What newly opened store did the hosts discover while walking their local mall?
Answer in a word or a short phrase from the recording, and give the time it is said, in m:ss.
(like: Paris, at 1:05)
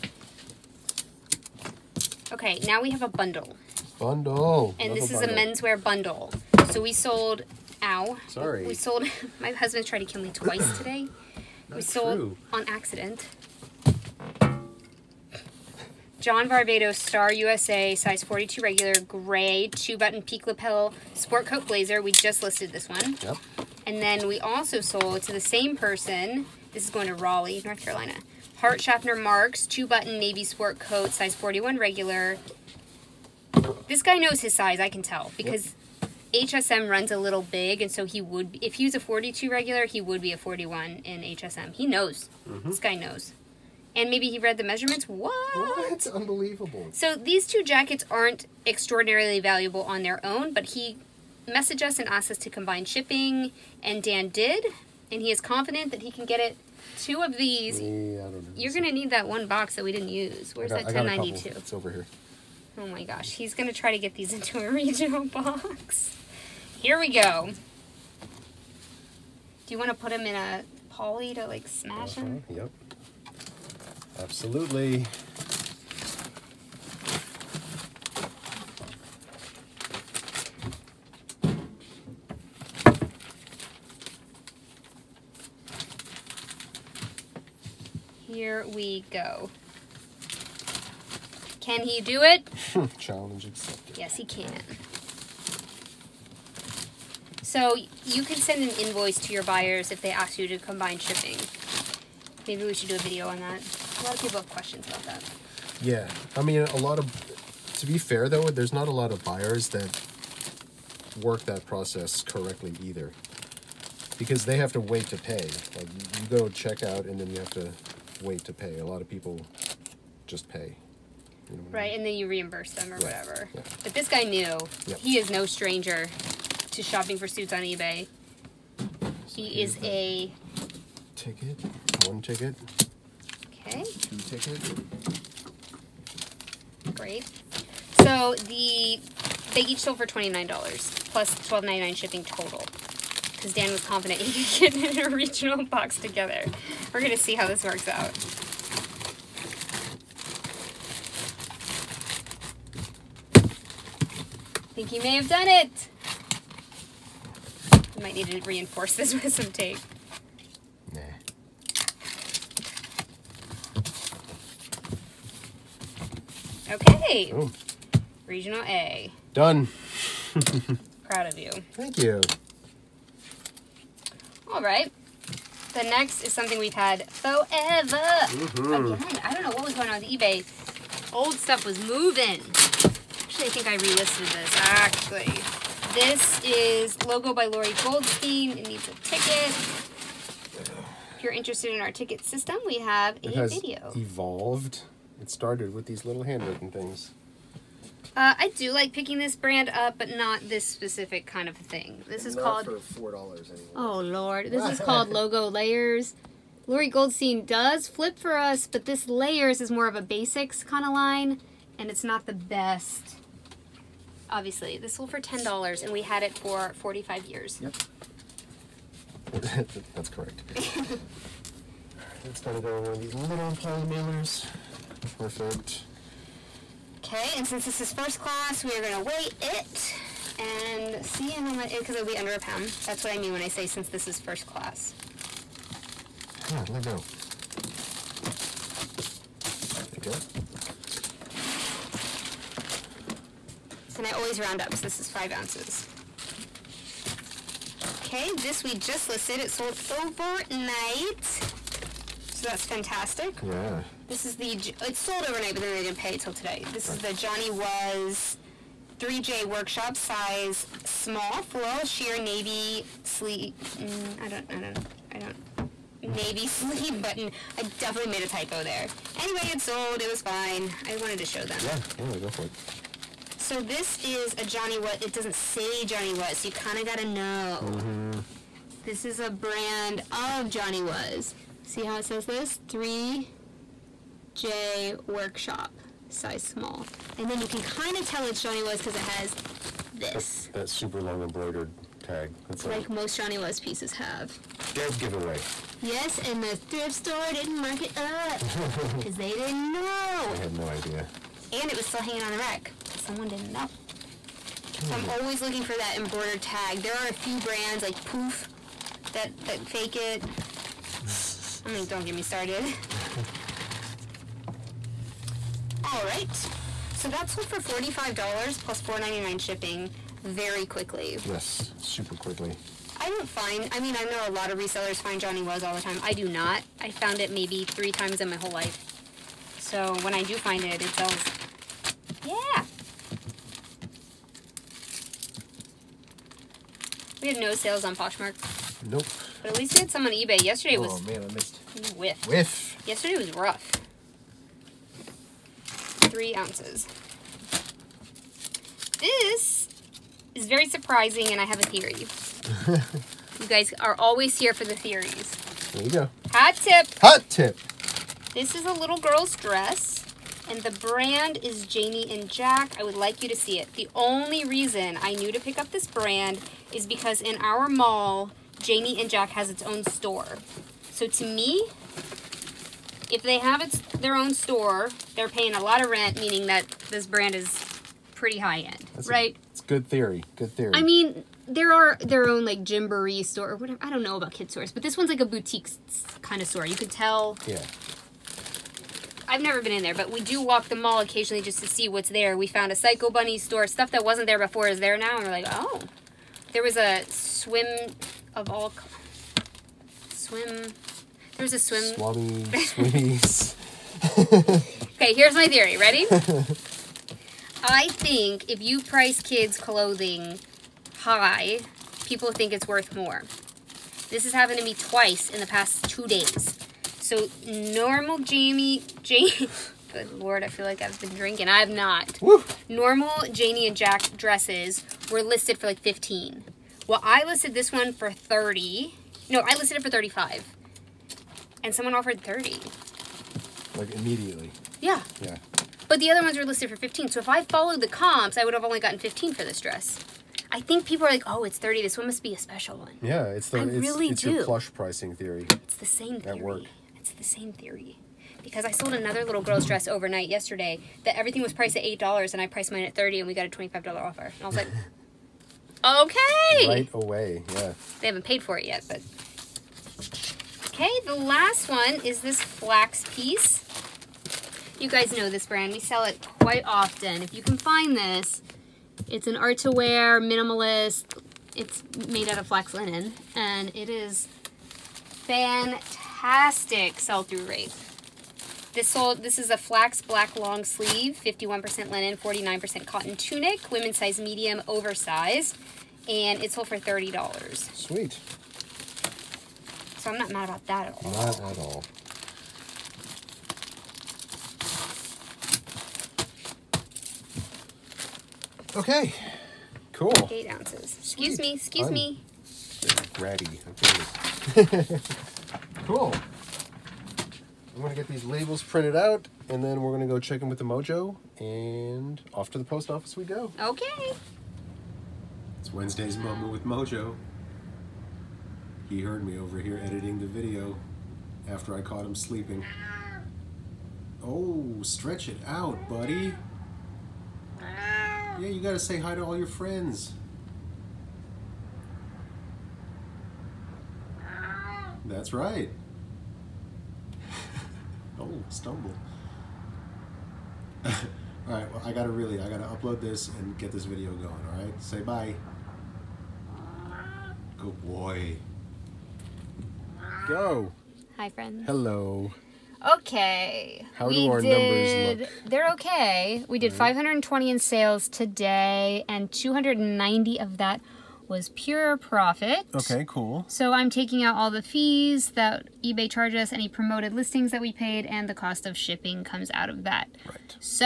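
Psycho Bunny, at 6:32.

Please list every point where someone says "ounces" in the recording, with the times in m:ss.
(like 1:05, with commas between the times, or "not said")
4:05, 5:46, 8:20.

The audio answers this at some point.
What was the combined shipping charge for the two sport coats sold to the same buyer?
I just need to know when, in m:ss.
2:21.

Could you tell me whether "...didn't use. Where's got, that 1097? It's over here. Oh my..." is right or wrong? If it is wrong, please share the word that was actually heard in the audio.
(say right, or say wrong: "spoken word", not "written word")
wrong: "1092", not "1097".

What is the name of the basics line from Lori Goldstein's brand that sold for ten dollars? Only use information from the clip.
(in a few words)
Logo Layers.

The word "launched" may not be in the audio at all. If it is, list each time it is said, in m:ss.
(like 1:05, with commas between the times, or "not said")
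not said.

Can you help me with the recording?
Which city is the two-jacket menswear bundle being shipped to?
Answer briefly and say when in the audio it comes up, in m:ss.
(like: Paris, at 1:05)
Raleigh, North Carolina, at 0:27.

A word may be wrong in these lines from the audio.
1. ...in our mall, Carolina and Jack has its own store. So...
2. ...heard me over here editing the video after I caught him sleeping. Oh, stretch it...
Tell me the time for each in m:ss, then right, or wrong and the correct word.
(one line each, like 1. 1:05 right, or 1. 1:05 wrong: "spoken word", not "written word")
1. 6:07 wrong: "Janie", not "Carolina"
2. 8:38 right.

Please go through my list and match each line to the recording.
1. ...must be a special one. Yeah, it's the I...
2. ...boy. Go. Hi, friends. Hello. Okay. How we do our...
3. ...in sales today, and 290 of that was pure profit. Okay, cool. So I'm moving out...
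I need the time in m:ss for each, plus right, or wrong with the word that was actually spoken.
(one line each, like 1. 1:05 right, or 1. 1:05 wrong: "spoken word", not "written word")
1. 7:22 right
2. 9:07 right
3. 9:17 wrong: "taking", not "moving".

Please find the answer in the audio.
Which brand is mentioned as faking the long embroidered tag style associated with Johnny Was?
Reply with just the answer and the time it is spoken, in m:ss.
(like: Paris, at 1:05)
Poof, at 5:08.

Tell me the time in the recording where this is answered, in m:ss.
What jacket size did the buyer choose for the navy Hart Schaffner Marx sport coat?
0:31.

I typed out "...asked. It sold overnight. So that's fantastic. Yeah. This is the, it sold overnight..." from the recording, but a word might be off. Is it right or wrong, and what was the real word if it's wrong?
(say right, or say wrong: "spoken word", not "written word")
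wrong: "listed", not "asked".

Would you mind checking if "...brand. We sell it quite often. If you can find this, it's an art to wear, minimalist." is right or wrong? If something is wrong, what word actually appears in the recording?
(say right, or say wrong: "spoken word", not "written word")
right.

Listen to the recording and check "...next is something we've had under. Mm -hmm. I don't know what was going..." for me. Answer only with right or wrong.
wrong.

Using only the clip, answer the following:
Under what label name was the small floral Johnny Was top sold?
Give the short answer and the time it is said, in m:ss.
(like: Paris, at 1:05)
3J Workshop, at 4:18.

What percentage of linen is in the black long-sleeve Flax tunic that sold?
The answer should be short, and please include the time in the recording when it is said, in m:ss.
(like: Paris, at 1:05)
51%, at 8:01.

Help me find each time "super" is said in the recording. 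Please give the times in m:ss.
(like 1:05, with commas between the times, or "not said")
4:50, 5:21.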